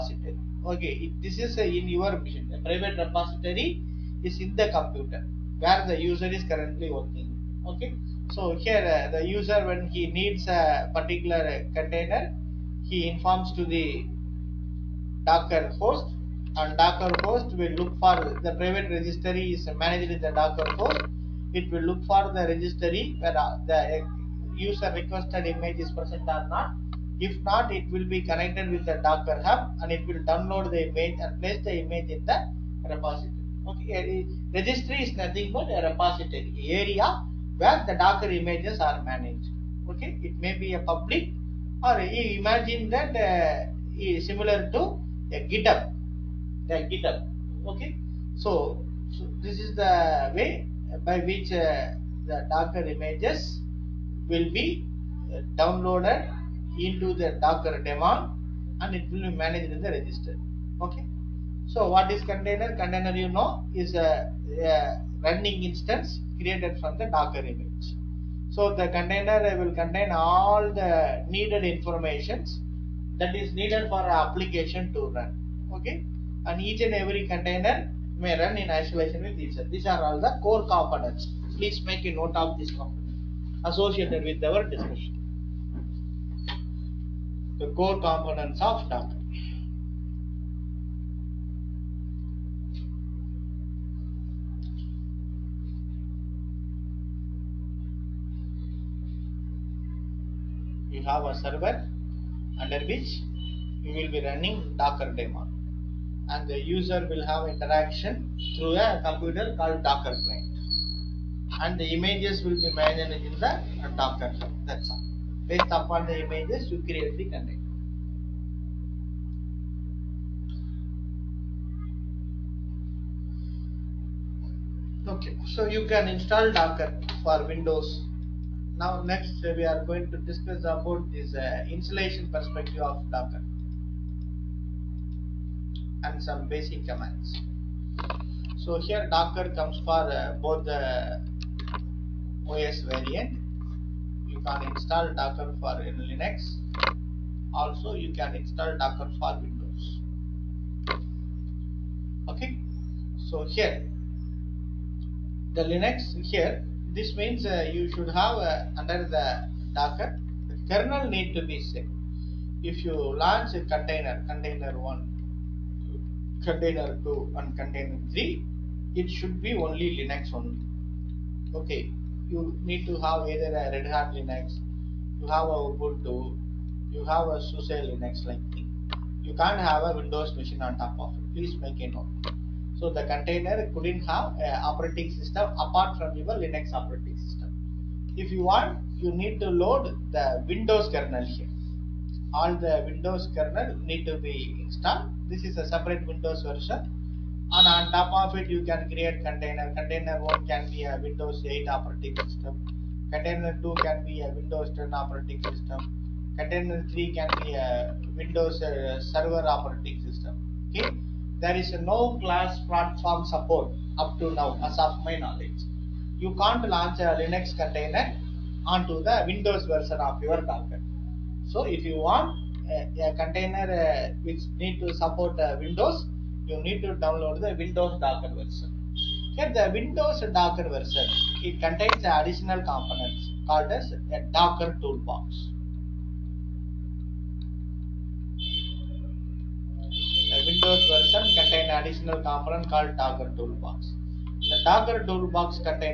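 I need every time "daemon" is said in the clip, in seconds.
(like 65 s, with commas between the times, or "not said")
57 s, 105 s.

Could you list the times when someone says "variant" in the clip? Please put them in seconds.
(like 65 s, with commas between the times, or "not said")
142 s.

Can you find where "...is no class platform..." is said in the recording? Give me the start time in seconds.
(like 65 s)
211 s.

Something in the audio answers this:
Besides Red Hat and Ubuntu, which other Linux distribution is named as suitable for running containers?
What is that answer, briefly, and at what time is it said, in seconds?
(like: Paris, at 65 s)
SUSE Linux, at 177 s.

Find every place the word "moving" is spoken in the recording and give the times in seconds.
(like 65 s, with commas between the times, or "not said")
not said.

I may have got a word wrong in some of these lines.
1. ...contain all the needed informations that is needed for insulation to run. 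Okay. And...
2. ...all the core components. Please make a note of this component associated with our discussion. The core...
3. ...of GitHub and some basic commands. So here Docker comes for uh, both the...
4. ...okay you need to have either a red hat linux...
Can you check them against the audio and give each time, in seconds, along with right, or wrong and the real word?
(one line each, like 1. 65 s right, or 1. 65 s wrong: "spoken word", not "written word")
1. 69 s wrong: "application", not "insulation"
2. 80 s right
3. 132 s wrong: "Docker", not "GitHub"
4. 171 s right.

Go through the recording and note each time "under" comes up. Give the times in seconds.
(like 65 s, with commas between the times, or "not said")
102 s, 158 s.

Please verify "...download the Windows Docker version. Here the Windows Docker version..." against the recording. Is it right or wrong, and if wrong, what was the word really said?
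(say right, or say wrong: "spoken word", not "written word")
right.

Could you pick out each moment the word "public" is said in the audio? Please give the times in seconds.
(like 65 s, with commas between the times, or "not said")
40 s.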